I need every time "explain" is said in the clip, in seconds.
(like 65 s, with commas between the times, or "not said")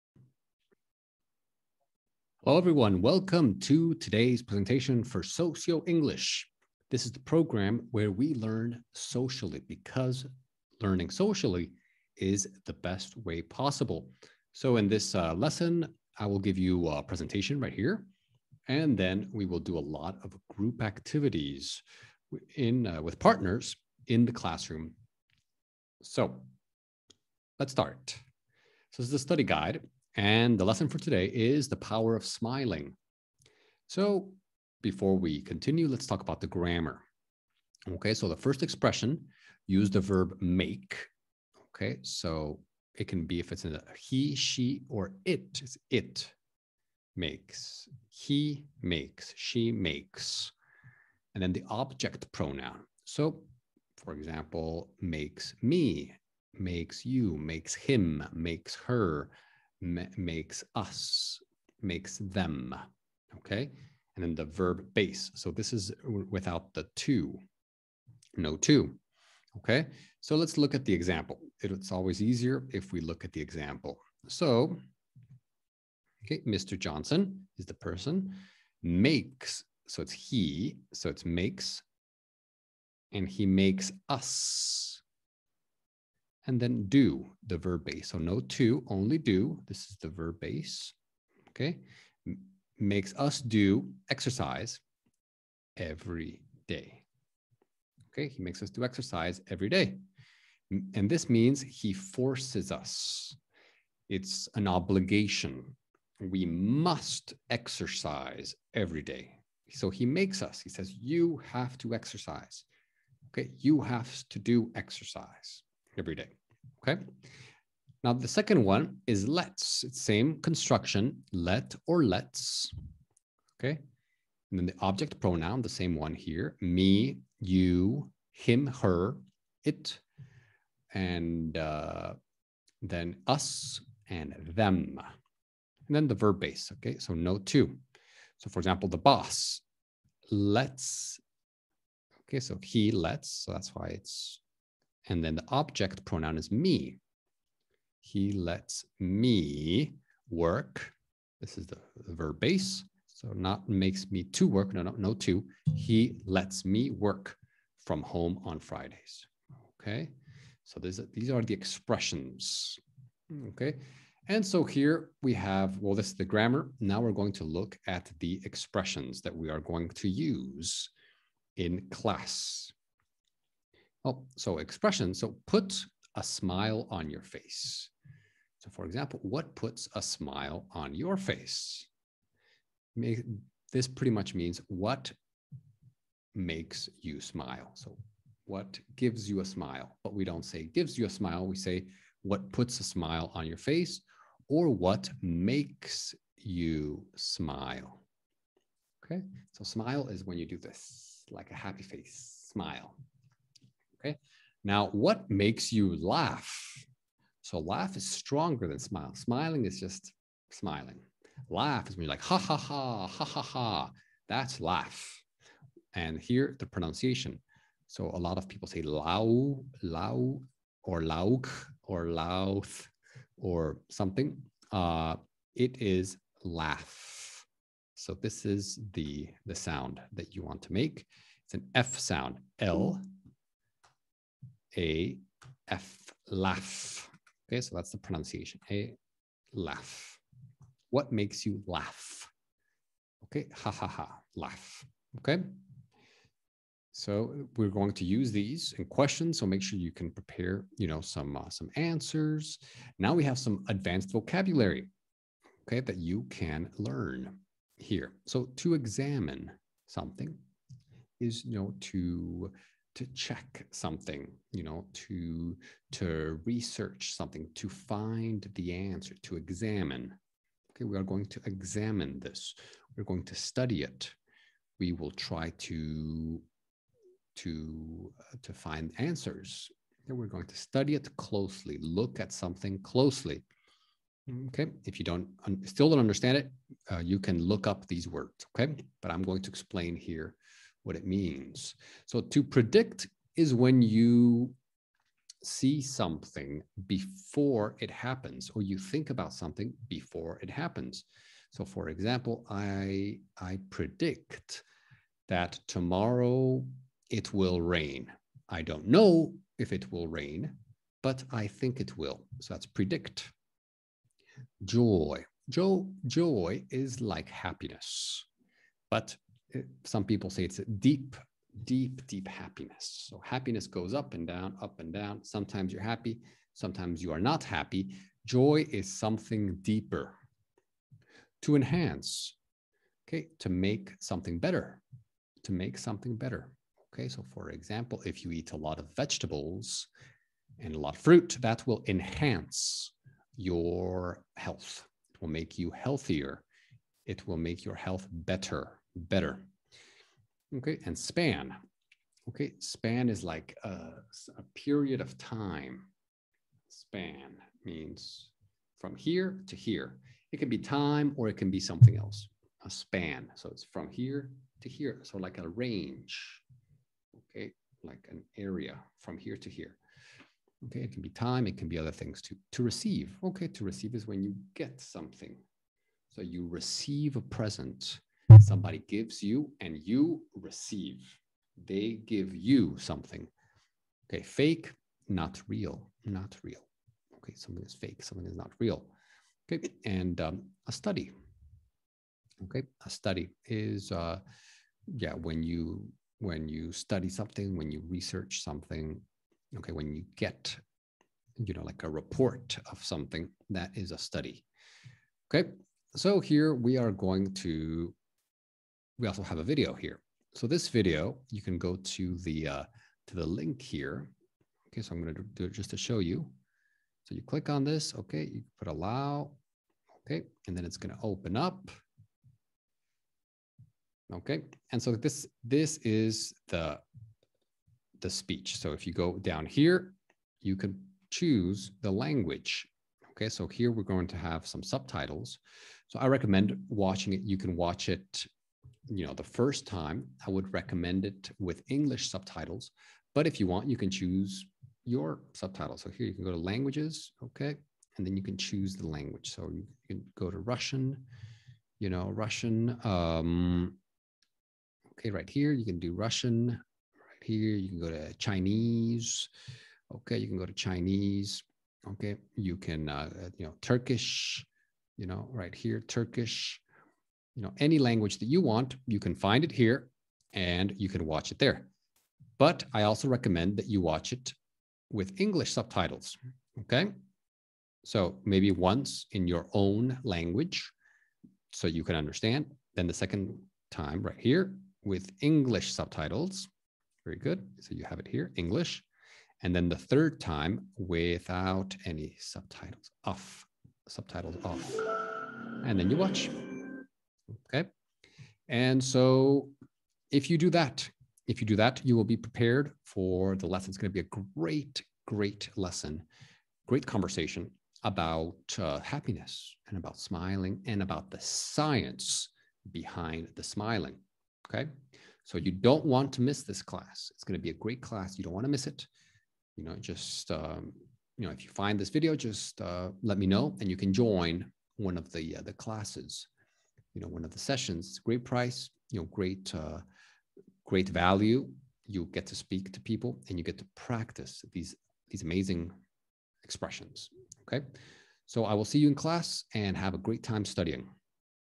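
289 s.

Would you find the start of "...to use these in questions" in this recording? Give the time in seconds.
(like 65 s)
247 s.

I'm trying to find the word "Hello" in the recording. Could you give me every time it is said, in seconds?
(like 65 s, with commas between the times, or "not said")
2 s.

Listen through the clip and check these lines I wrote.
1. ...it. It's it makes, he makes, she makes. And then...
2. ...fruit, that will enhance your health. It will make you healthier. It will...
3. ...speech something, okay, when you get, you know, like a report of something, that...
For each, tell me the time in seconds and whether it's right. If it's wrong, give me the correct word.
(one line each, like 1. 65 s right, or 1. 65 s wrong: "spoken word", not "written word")
1. 45 s right
2. 341 s right
3. 397 s wrong: "research", not "speech".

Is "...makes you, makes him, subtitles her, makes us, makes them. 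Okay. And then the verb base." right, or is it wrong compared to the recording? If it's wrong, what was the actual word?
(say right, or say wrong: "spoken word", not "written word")
wrong: "makes", not "subtitles".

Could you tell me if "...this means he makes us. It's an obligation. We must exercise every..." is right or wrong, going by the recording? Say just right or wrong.
wrong.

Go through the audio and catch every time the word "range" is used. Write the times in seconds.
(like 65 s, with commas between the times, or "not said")
365 s.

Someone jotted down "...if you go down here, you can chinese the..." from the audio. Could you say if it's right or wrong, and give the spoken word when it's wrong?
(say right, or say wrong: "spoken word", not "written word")
wrong: "choose", not "chinese".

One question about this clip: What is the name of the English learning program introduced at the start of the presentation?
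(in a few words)
Socio English.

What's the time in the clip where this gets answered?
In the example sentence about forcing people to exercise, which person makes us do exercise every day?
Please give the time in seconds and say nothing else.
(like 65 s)
76 s.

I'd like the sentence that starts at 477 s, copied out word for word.
So maybe once in your own language so you can understand.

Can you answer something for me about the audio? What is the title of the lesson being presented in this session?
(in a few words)
The power of smiling.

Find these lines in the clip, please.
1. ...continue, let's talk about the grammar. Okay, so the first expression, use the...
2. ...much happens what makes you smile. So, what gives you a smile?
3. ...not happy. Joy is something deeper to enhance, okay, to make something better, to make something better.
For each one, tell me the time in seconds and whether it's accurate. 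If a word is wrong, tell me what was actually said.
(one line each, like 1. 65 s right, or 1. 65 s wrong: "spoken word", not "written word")
1. 35 s right
2. 184 s wrong: "means", not "happens"
3. 327 s right.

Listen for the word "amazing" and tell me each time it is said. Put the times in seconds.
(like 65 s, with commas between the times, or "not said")
535 s.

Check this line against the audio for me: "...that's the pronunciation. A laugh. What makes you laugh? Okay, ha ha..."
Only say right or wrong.
right.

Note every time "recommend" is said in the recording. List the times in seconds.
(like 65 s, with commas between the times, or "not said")
436 s, 440 s, 473 s.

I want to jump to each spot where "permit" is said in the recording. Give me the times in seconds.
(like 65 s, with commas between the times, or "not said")
not said.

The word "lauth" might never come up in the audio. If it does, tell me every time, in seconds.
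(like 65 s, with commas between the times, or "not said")
222 s.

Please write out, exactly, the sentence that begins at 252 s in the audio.
Now we have some advanced vocabulary, okay, that you can learn here.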